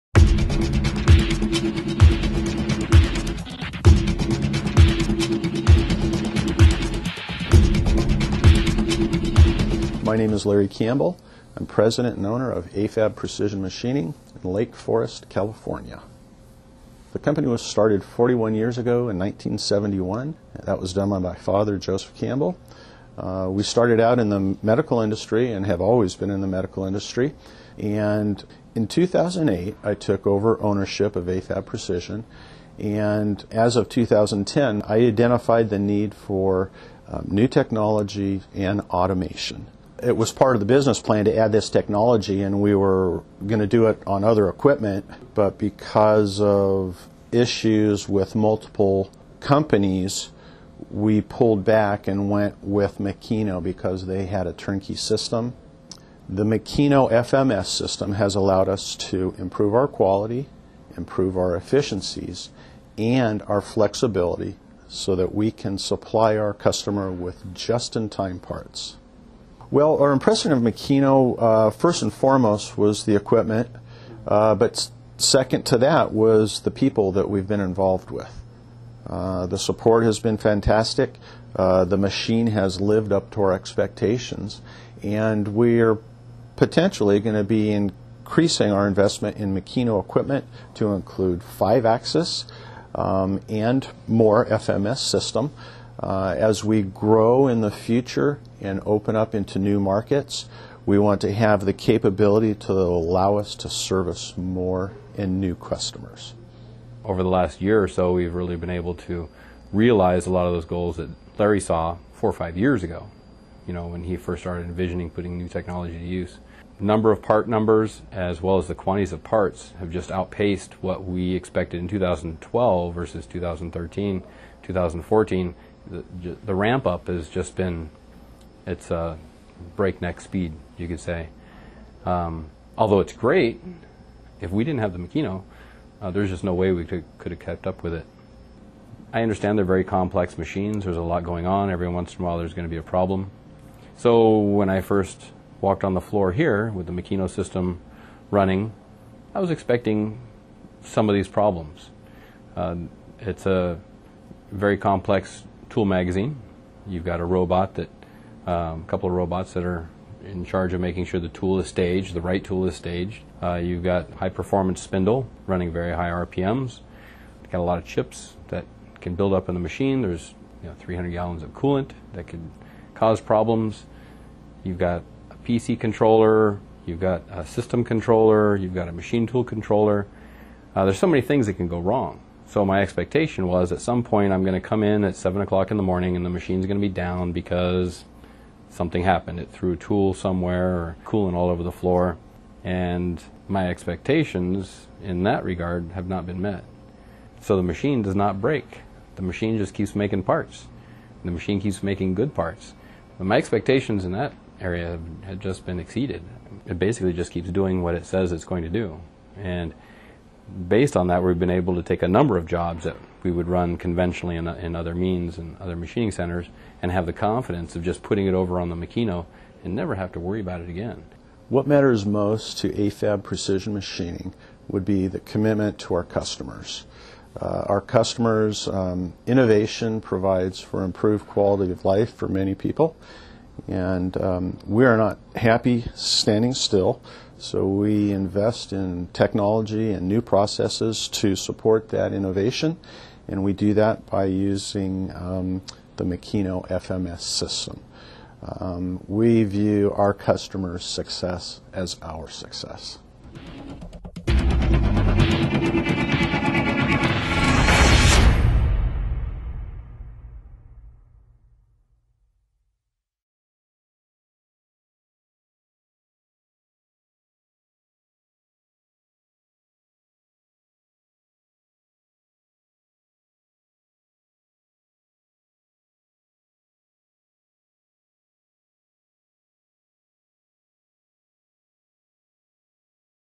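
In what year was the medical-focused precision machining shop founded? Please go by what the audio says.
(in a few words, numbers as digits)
1971.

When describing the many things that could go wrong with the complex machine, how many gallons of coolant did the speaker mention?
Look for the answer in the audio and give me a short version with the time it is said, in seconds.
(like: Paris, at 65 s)
300, at 170 s.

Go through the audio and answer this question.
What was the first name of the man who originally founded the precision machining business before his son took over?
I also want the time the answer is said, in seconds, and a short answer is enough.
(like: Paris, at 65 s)
Joseph, at 21 s.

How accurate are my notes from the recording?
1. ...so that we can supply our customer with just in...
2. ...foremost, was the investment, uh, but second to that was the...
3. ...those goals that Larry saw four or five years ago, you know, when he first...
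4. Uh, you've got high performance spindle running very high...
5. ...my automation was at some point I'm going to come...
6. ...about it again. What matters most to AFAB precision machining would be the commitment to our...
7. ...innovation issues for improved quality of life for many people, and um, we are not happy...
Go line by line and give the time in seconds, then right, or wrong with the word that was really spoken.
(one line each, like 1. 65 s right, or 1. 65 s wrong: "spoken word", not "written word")
1. 64 s right
2. 72 s wrong: "equipment", not "investment"
3. 110 s right
4. 163 s right
5. 182 s wrong: "expectation", not "automation"
6. 220 s right
7. 229 s wrong: "provides", not "issues".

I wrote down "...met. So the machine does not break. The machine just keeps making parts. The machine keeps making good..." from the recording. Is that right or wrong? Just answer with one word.
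right.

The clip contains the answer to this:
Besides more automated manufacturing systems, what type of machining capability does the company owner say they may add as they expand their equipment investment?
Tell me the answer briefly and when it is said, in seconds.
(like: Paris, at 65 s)
five axis, at 91 s.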